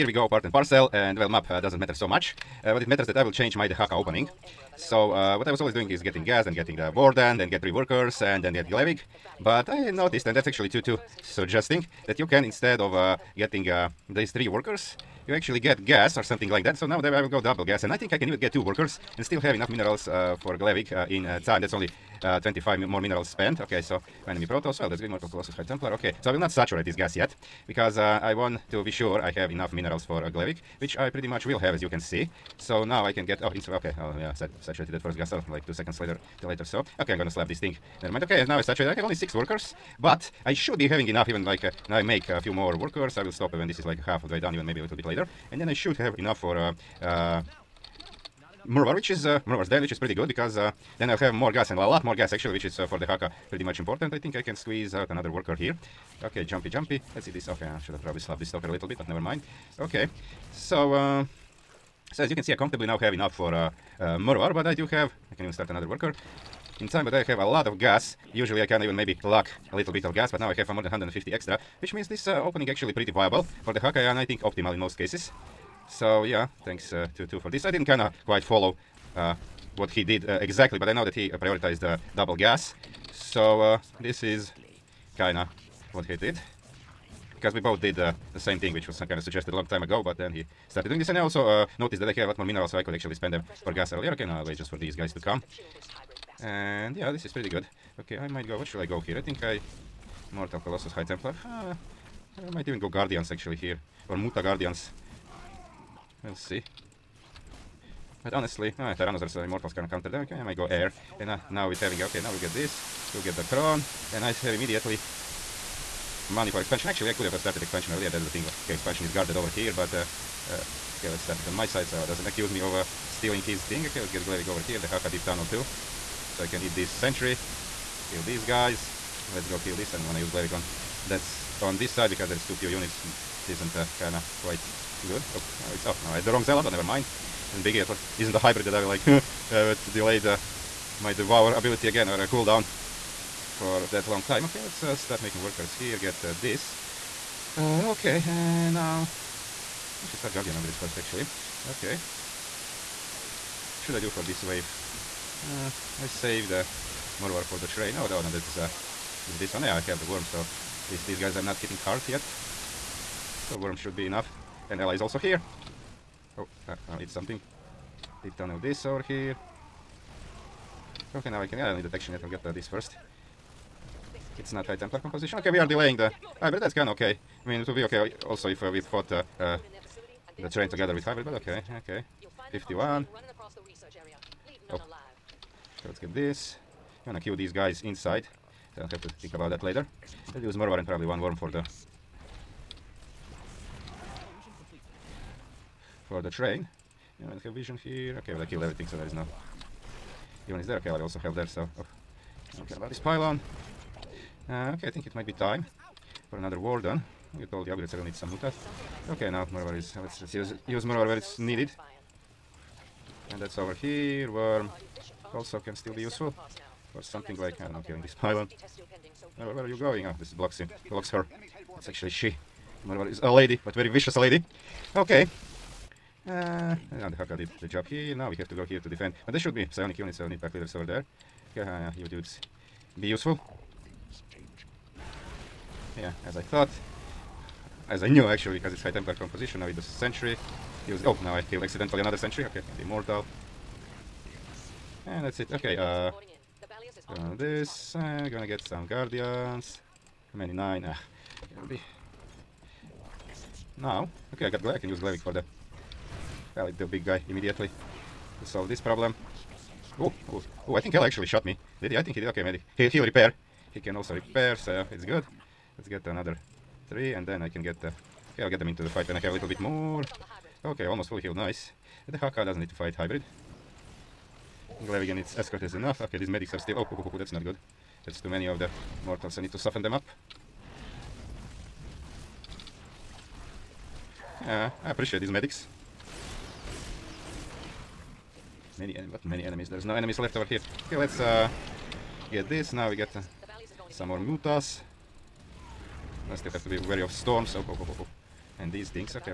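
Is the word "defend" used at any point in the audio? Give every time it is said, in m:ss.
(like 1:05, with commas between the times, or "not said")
3:48.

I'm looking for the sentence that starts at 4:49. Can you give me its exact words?
There's no enemies left over here.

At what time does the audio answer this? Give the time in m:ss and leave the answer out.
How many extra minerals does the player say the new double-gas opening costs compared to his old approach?
0:22.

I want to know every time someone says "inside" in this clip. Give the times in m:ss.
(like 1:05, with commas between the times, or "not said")
3:07.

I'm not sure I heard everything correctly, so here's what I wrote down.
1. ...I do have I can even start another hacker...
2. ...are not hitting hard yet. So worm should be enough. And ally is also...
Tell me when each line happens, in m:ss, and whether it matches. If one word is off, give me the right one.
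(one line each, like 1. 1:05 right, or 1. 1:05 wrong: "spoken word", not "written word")
1. 1:04 wrong: "worker", not "hacker"
2. 2:41 right.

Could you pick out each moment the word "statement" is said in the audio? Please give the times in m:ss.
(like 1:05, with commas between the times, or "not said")
not said.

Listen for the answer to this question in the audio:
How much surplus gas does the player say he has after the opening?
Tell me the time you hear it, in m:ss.
1:10.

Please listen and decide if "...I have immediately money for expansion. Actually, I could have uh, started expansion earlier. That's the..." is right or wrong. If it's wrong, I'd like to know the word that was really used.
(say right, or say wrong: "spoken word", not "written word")
right.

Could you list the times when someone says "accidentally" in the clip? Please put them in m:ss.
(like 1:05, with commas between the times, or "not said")
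4:01.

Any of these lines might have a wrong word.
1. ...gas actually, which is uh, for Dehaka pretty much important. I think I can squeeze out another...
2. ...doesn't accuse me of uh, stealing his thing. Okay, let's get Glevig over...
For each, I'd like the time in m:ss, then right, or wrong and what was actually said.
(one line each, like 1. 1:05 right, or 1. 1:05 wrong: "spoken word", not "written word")
1. 0:52 right
2. 2:02 right.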